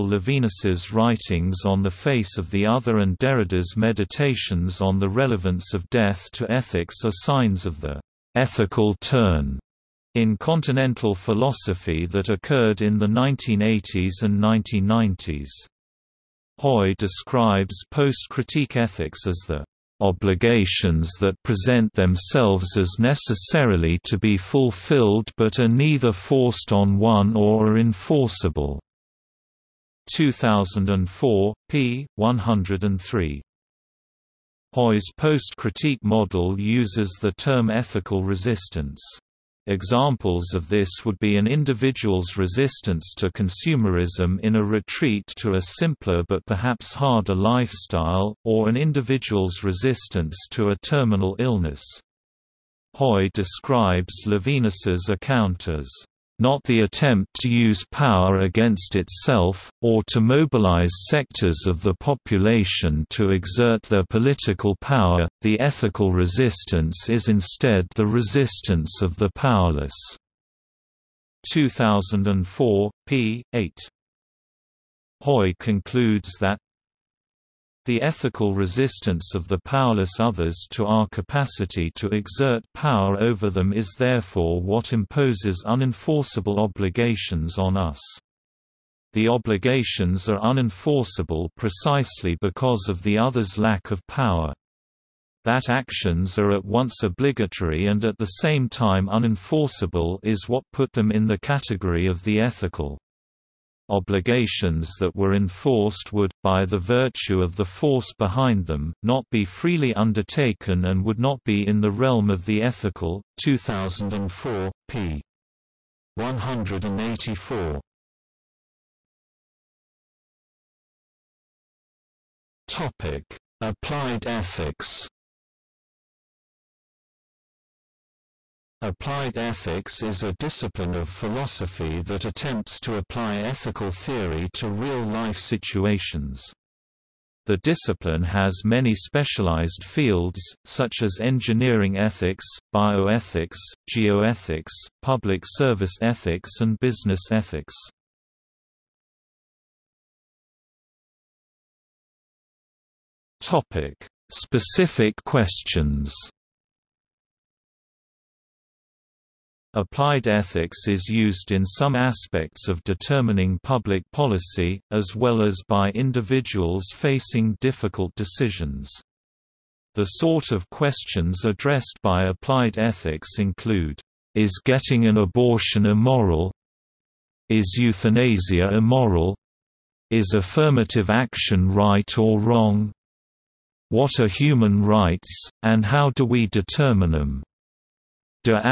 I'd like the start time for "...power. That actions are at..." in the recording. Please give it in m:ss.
1:34.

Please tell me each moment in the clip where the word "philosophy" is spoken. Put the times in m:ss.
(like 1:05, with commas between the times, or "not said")
0:11, 2:11.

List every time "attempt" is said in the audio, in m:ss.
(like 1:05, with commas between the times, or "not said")
0:56, 2:12.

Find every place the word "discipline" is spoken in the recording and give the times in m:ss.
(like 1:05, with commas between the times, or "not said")
2:10, 2:17.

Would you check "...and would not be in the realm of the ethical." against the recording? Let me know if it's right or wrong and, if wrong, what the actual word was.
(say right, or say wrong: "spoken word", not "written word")
right.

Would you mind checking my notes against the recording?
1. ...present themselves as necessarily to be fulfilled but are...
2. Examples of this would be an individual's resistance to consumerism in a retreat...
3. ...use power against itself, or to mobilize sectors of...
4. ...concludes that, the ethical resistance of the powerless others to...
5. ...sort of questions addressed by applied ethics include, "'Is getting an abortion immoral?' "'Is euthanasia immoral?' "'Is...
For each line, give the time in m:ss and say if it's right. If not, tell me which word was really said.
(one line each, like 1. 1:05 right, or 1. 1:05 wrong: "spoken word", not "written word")
1. 0:21 right
2. 0:39 right
3. 0:57 right
4. 1:15 right
5. 2:50 right.